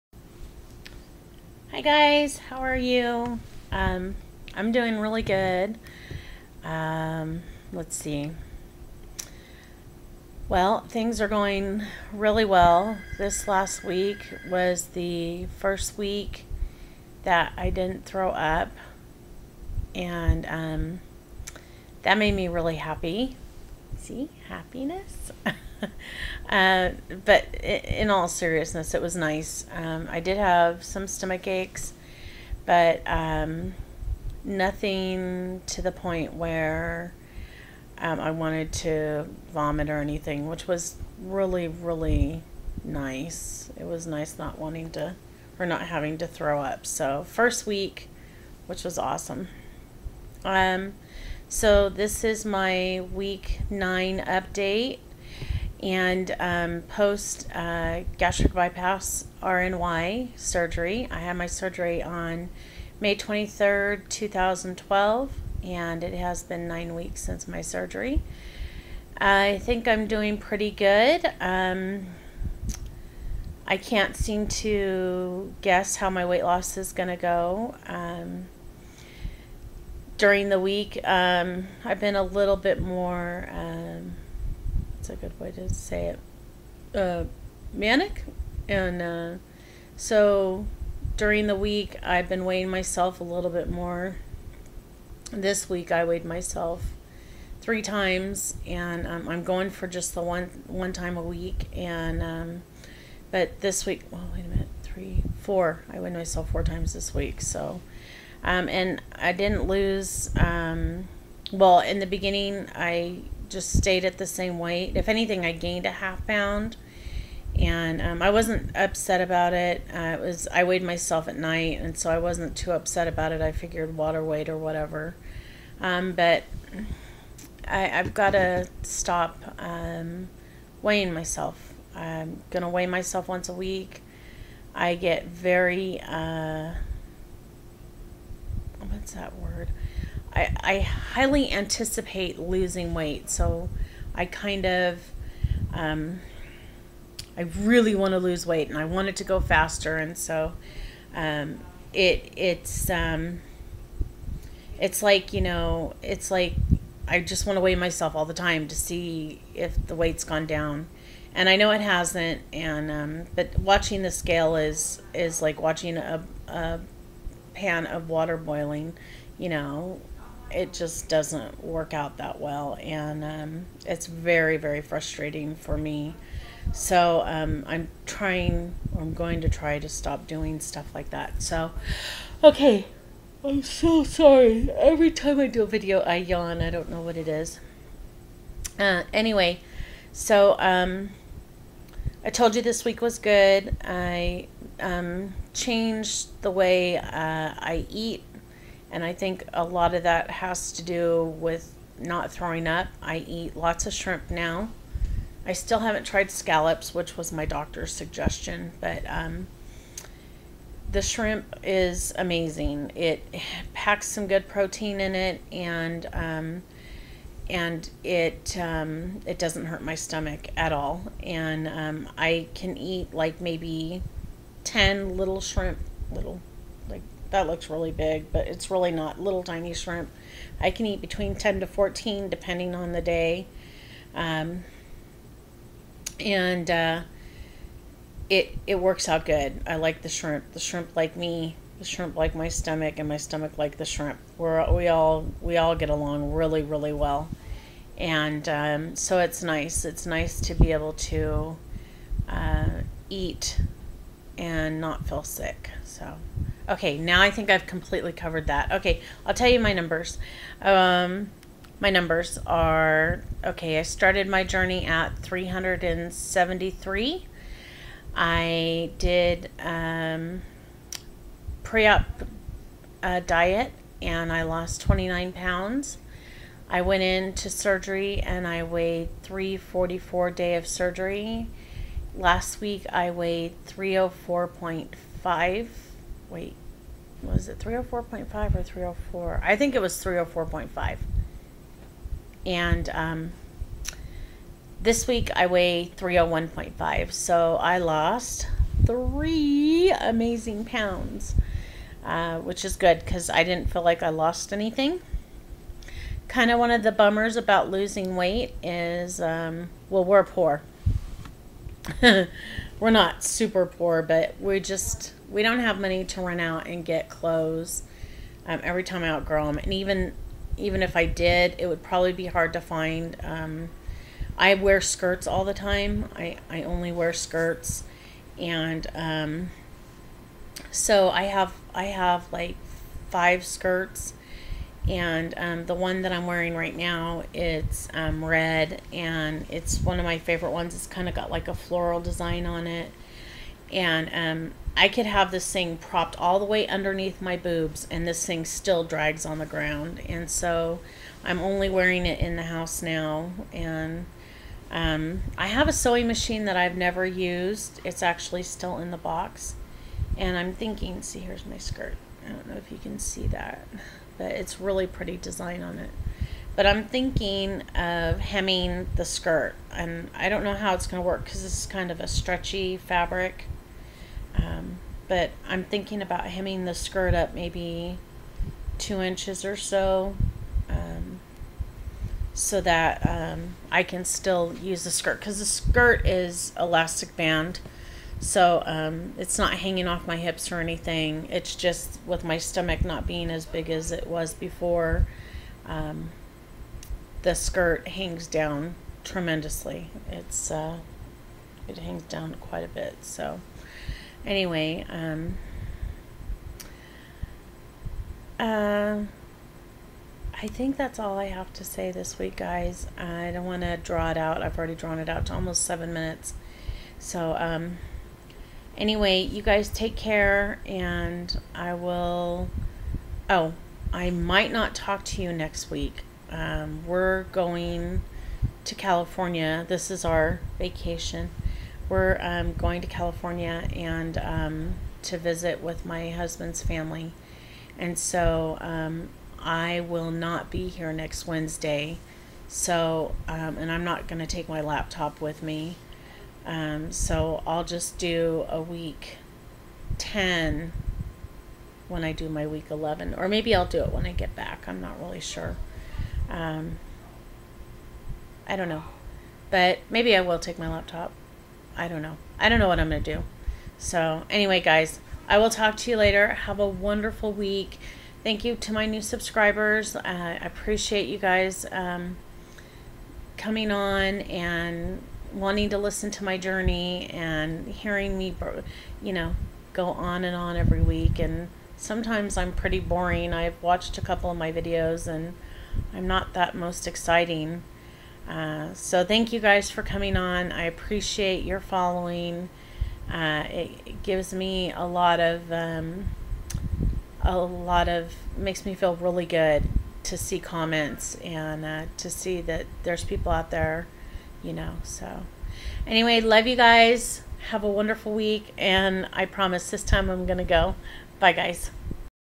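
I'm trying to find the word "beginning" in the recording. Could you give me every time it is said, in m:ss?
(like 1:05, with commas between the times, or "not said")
1:52.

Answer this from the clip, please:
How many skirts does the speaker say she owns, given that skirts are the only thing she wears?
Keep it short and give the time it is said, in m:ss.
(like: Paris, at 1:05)
5, at 5:33.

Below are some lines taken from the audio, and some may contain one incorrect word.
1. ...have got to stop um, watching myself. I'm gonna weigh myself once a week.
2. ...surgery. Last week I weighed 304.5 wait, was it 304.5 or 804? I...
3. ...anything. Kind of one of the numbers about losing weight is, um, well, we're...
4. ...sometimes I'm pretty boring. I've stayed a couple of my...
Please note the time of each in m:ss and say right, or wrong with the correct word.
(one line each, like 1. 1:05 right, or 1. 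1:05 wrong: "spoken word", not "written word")
1. 2:07 wrong: "weighing", not "watching"
2. 4:40 wrong: "304", not "804"
3. 5:04 wrong: "bummers", not "numbers"
4. 8:01 wrong: "watched", not "stayed".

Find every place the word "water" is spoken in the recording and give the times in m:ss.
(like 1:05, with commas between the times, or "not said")
2:03, 2:48.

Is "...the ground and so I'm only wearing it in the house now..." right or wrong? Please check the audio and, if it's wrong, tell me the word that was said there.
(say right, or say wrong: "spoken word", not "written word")
right.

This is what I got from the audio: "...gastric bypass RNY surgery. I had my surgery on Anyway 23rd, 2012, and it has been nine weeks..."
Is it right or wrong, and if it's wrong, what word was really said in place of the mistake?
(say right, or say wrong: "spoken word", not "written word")
wrong: "May", not "Anyway".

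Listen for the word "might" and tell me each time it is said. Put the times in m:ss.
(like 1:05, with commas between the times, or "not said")
7:04.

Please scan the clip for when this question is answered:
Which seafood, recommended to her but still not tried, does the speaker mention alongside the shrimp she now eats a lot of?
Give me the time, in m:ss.
3:26.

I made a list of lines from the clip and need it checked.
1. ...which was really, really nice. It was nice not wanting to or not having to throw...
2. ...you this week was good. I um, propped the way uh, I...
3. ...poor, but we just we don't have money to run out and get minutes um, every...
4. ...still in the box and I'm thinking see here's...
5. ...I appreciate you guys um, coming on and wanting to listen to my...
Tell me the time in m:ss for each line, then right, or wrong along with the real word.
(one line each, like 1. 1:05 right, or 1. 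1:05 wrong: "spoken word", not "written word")
1. 0:40 right
2. 3:12 wrong: "changed", not "propped"
3. 5:13 wrong: "clothes", not "minutes"
4. 5:58 right
5. 7:50 right.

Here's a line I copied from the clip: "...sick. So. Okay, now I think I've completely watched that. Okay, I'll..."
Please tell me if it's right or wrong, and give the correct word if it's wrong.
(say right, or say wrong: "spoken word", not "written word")
wrong: "covered", not "watched".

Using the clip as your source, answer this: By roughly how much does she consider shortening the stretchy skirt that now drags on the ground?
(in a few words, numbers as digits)
2 inches.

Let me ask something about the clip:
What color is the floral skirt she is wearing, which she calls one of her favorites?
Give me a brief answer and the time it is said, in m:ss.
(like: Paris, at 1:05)
red, at 5:38.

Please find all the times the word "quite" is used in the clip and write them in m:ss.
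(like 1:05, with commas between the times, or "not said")
6:42.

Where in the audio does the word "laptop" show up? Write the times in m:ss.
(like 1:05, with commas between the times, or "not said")
7:24, 7:40.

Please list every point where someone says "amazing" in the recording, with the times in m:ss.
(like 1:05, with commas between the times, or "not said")
3:32, 4:59.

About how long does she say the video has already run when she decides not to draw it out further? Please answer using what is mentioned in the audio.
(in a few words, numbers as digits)
almost 7 minutes.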